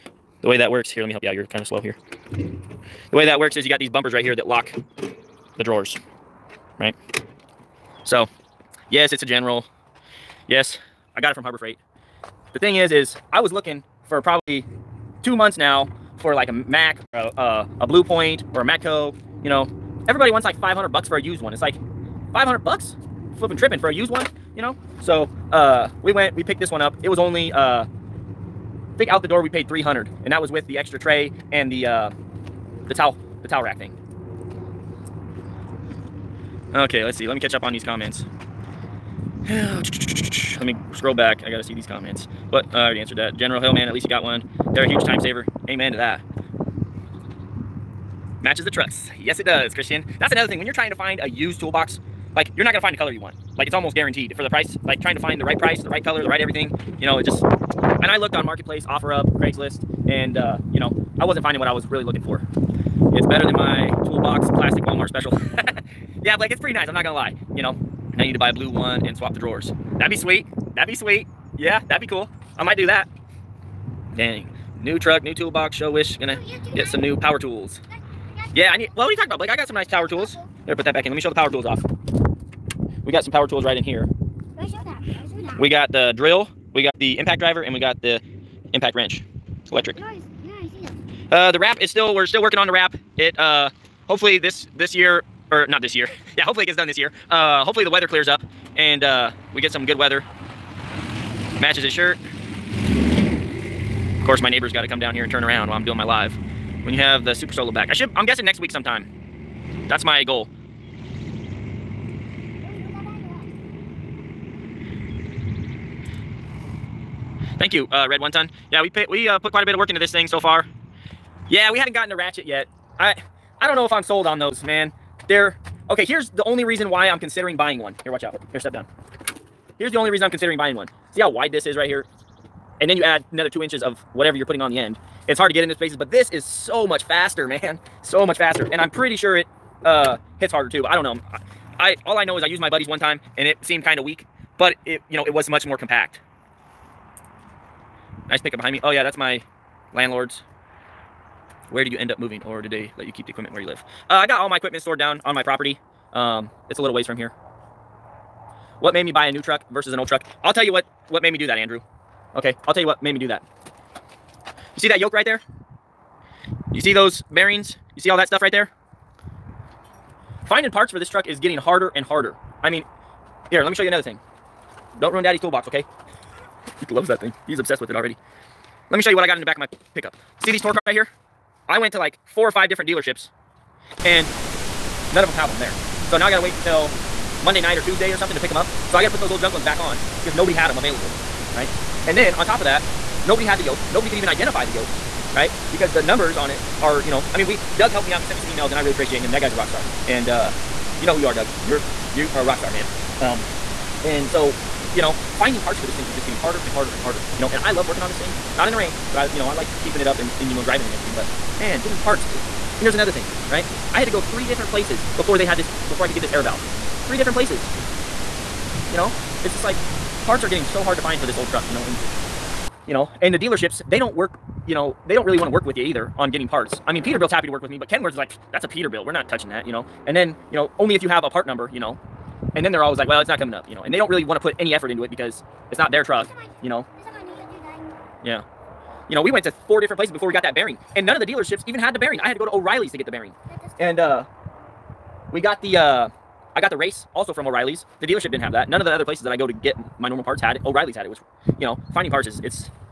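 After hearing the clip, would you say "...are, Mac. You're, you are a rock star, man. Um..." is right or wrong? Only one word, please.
wrong.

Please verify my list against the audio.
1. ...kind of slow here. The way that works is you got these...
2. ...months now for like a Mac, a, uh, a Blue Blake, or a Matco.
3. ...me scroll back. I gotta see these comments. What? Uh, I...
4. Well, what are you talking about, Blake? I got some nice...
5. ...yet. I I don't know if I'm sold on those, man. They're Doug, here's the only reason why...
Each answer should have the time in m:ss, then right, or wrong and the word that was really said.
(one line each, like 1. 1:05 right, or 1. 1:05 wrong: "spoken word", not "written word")
1. 0:01 right
2. 0:15 wrong: "Point", not "Blake"
3. 0:40 right
4. 1:18 right
5. 2:02 wrong: "Okay", not "Doug".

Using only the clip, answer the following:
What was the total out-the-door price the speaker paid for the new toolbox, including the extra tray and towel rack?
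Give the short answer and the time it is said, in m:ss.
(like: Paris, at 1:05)
$300, at 0:29.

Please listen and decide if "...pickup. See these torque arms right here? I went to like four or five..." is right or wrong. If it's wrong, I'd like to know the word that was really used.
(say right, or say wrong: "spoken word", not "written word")
right.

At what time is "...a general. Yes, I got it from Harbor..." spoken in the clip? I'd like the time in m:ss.
0:09.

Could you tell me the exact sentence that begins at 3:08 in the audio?
So I got to put those old junk ones back on because nobody had them available, right?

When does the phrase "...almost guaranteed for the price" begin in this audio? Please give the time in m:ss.
0:53.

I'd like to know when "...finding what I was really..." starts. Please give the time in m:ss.
1:01.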